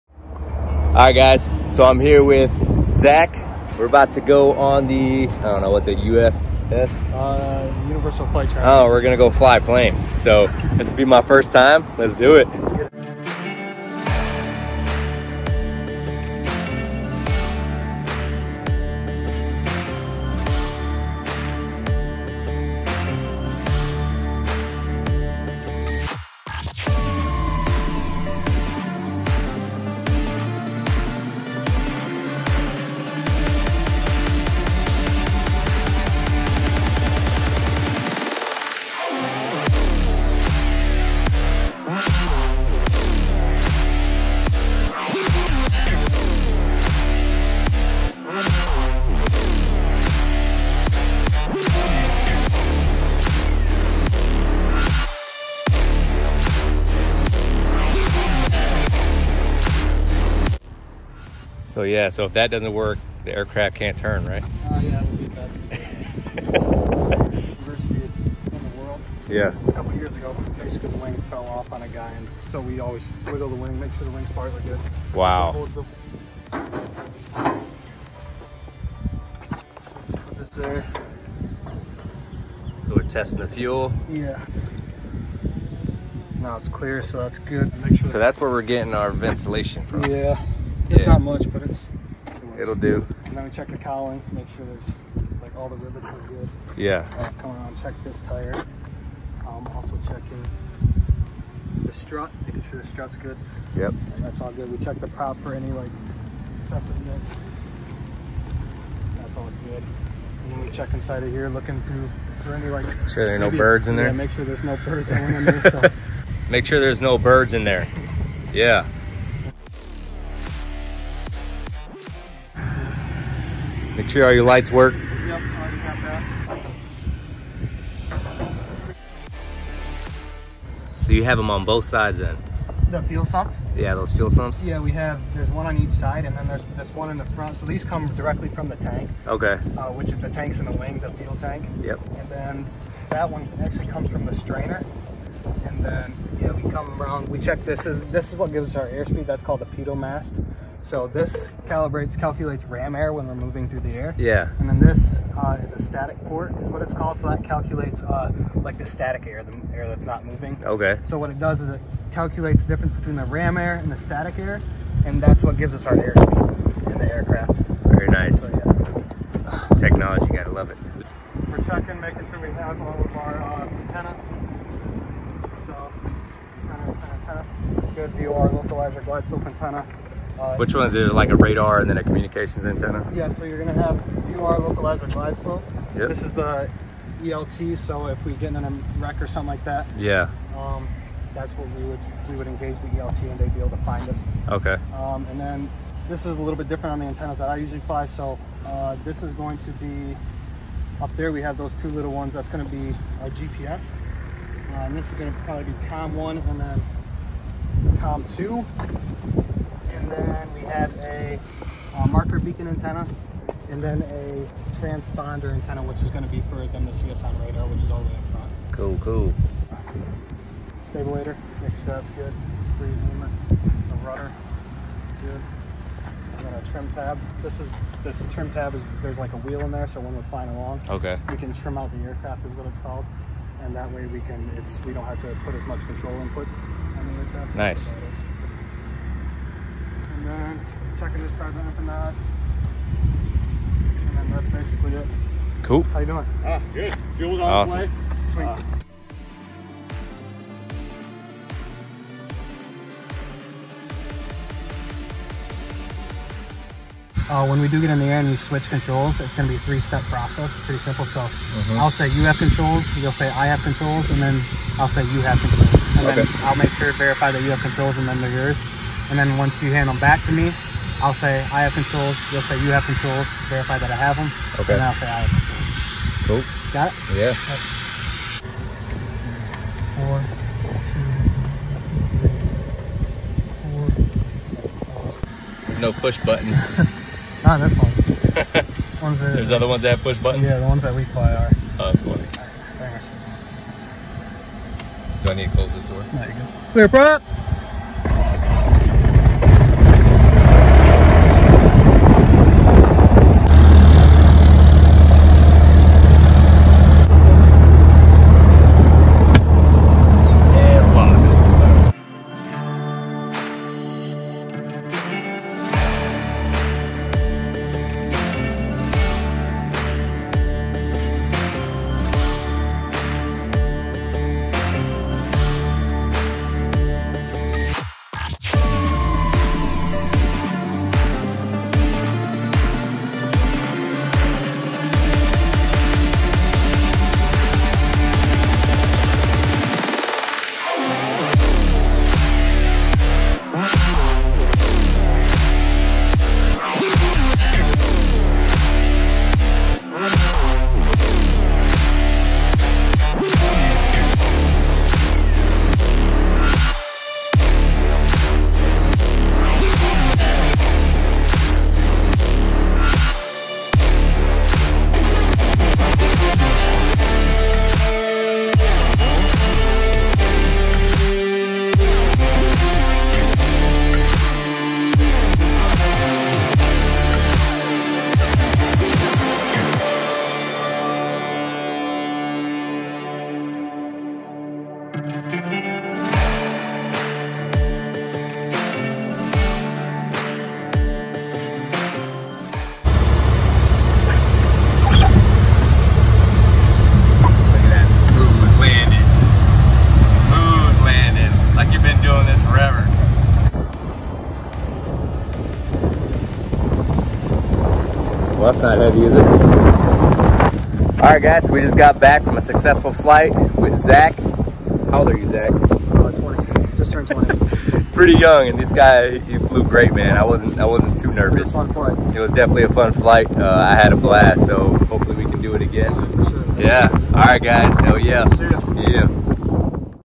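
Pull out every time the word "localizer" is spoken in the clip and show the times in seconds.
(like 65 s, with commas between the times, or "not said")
178 s, 184 s.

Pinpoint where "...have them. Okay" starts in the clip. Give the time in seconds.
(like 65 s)
273 s.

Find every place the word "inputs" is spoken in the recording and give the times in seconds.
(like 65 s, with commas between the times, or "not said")
236 s.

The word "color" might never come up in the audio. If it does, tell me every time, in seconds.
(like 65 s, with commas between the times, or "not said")
not said.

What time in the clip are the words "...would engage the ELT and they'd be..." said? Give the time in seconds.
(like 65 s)
192 s.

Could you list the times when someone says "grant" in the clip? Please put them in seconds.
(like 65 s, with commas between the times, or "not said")
not said.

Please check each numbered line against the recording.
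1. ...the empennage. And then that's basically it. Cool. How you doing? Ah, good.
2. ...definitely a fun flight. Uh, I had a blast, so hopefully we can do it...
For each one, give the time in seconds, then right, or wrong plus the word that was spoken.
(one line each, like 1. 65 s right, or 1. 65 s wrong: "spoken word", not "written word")
1. 241 s right
2. 422 s right.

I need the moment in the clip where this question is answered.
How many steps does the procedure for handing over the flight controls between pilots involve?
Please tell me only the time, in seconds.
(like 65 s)
259 s.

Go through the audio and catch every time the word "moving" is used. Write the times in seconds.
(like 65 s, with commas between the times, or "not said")
153 s, 160 s.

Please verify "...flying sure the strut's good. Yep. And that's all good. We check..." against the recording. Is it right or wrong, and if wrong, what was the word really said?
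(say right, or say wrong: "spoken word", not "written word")
wrong: "making", not "flying".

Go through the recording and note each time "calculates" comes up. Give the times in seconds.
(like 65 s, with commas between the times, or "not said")
152 s, 157 s, 162 s.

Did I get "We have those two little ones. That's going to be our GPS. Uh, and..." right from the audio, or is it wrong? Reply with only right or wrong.
right.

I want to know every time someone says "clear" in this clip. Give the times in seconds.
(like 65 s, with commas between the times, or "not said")
86 s, 296 s.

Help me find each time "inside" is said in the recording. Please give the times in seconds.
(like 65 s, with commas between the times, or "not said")
110 s.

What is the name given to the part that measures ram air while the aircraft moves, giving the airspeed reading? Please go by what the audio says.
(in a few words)
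Pitot mast.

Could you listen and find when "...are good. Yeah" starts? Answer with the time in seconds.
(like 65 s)
96 s.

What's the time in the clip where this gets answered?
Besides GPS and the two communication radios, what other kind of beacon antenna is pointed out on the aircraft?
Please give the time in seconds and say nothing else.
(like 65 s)
212 s.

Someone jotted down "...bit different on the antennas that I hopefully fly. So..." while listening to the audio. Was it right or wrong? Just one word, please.
wrong.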